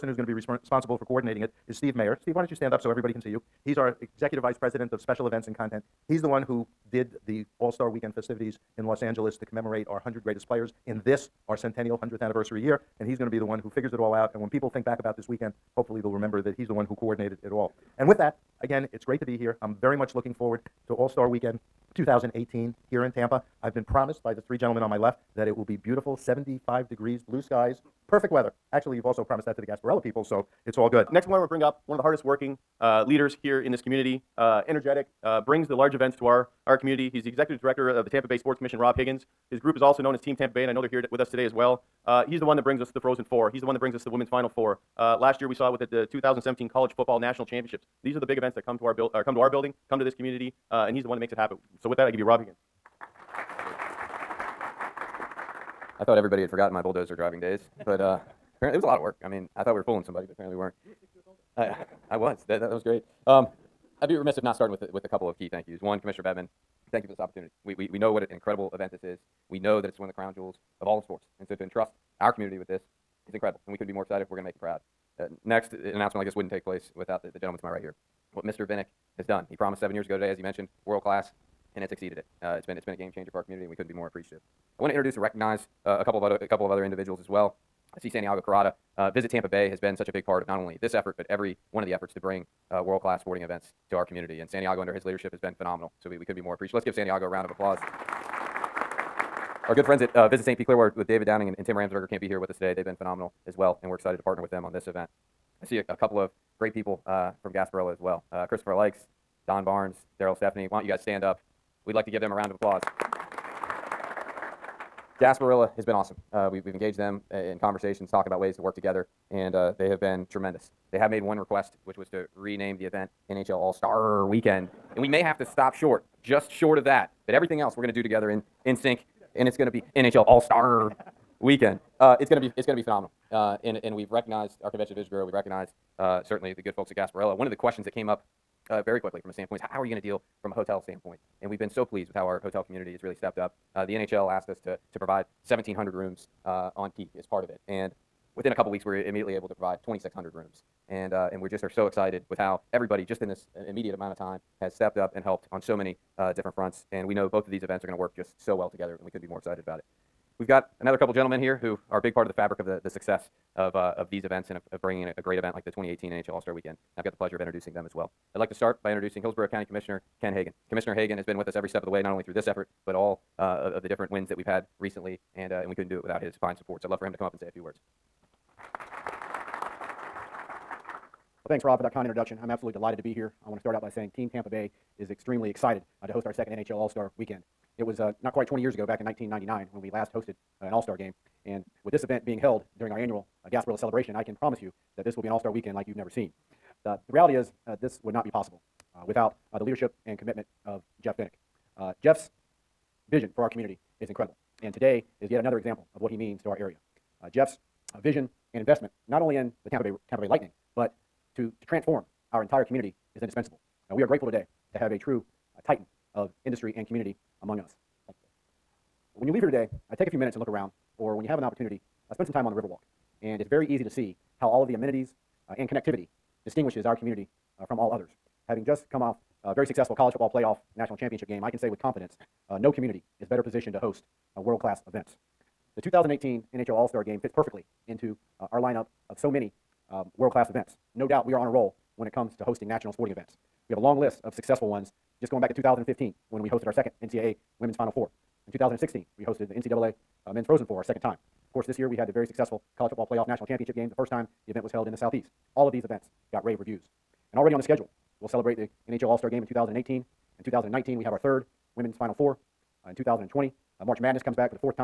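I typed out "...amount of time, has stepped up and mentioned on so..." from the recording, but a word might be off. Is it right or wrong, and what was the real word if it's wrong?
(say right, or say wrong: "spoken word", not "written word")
wrong: "helped", not "mentioned".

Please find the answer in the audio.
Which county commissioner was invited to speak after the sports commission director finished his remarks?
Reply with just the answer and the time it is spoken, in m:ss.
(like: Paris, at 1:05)
Ken Hagan, at 2:50.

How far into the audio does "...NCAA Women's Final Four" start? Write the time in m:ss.
4:07.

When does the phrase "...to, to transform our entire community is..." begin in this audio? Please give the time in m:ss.
3:31.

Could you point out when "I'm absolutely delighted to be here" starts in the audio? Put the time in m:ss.
3:02.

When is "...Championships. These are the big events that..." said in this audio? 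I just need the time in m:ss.
0:47.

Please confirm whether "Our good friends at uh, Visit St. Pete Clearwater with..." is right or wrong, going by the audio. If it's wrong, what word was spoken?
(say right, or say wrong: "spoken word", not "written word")
right.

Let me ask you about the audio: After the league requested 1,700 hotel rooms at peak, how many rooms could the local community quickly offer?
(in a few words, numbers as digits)
2,600.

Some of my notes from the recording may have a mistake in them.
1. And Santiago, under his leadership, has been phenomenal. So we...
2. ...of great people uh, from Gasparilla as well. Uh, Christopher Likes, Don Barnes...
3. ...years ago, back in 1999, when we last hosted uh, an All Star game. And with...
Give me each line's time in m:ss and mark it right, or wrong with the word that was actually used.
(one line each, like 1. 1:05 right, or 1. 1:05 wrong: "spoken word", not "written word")
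1. 1:34 right
2. 1:46 right
3. 3:08 right.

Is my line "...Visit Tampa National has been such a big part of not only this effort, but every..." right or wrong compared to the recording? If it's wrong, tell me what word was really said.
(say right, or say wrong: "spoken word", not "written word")
wrong: "Bay", not "National".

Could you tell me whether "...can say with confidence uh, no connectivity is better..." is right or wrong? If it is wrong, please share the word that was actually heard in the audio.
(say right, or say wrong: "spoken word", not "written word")
wrong: "community", not "connectivity".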